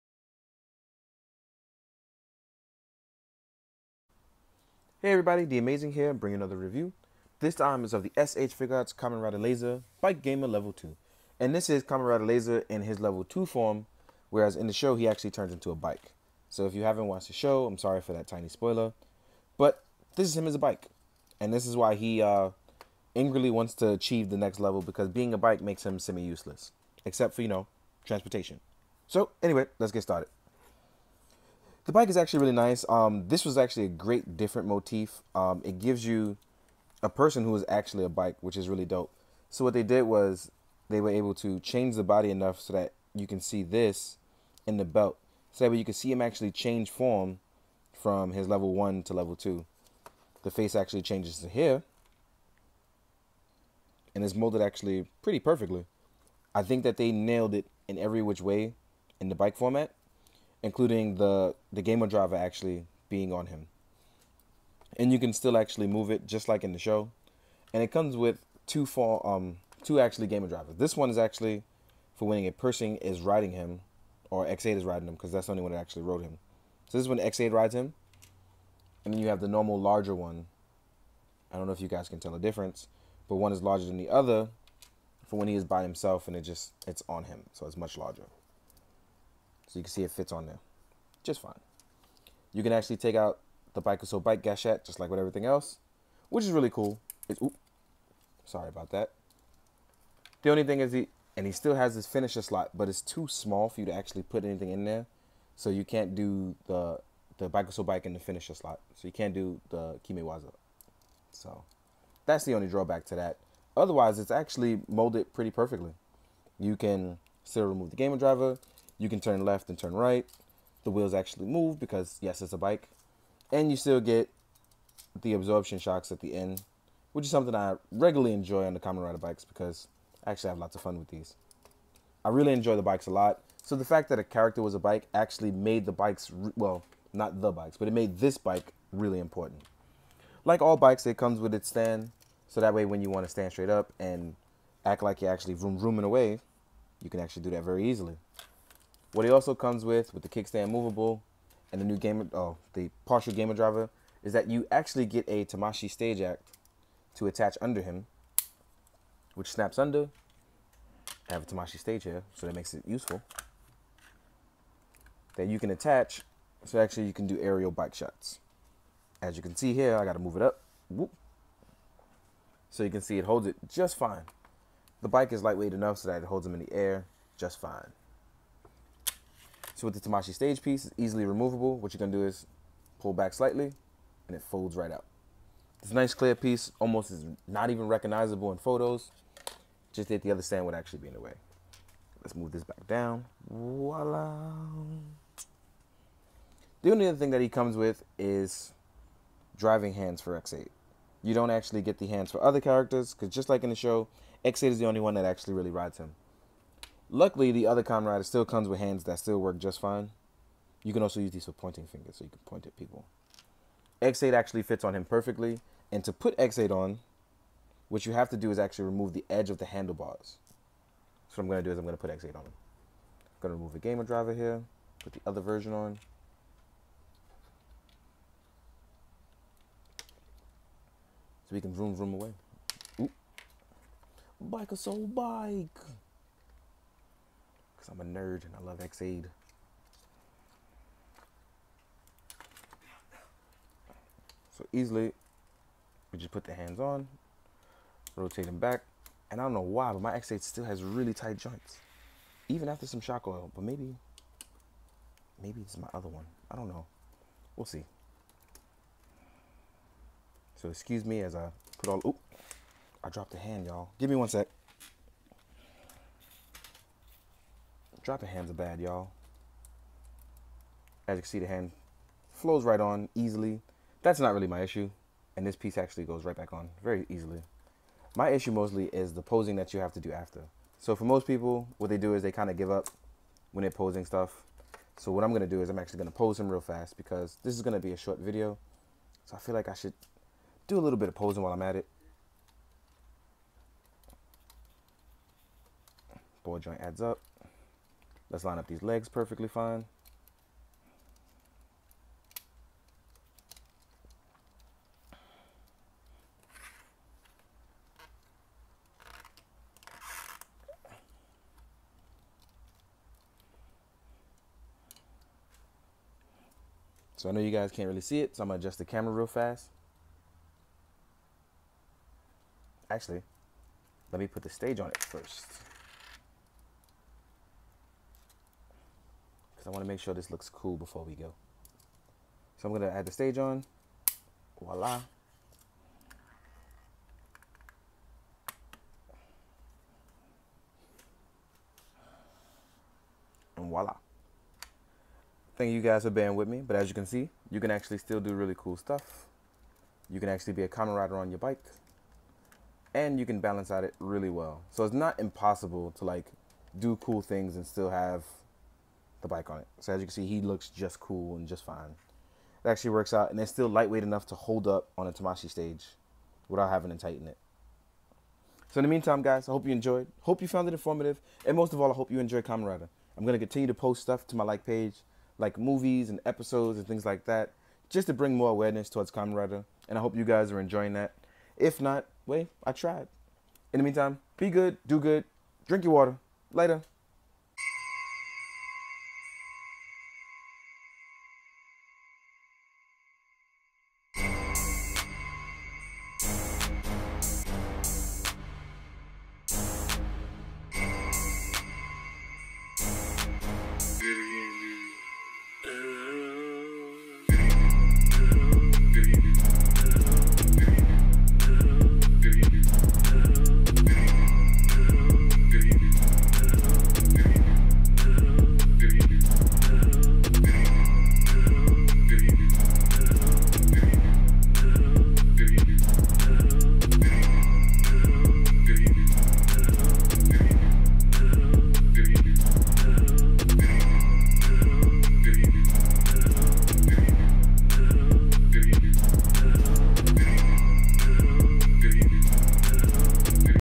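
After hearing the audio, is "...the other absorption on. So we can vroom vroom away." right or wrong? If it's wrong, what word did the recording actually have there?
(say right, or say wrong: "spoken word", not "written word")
wrong: "version", not "absorption".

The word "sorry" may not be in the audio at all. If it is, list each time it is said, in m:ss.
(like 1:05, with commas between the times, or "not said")
0:17, 1:38.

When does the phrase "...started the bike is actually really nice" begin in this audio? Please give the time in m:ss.
0:30.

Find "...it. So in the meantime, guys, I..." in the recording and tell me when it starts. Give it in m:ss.
6:07.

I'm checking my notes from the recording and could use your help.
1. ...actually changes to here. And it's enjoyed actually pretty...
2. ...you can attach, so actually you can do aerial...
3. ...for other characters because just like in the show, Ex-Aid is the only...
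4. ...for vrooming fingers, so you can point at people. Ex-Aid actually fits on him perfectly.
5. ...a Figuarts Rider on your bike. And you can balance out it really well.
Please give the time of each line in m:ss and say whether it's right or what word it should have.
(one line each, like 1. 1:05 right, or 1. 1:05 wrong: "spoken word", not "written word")
1. 0:50 wrong: "molded", not "enjoyed"
2. 2:45 right
3. 3:22 right
4. 3:31 wrong: "pointing", not "vrooming"
5. 5:50 wrong: "Kamen", not "Figuarts".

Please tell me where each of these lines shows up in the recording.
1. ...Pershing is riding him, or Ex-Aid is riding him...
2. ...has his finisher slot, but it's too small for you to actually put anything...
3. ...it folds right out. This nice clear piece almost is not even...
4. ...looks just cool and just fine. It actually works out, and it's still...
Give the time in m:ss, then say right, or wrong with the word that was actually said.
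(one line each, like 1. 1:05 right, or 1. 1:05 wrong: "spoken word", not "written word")
1. 1:12 right
2. 1:41 right
3. 3:04 right
4. 6:00 right.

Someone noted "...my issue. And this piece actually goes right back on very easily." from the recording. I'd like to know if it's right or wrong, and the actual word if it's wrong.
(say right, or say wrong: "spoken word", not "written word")
right.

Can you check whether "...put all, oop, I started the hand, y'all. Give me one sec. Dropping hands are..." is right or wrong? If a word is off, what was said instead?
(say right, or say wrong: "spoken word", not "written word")
wrong: "dropped", not "started".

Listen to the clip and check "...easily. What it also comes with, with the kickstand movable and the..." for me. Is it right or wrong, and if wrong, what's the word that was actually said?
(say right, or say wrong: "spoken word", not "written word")
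right.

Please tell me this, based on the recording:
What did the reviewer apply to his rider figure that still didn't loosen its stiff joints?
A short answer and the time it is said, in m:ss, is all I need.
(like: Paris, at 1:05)
shock oil, at 4:12.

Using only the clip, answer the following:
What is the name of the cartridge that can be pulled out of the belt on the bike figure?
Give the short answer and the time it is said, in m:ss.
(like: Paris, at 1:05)
Bakusou Bike Gashat, at 1:33.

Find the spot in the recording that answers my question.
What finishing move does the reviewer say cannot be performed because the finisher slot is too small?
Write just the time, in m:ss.
1:50.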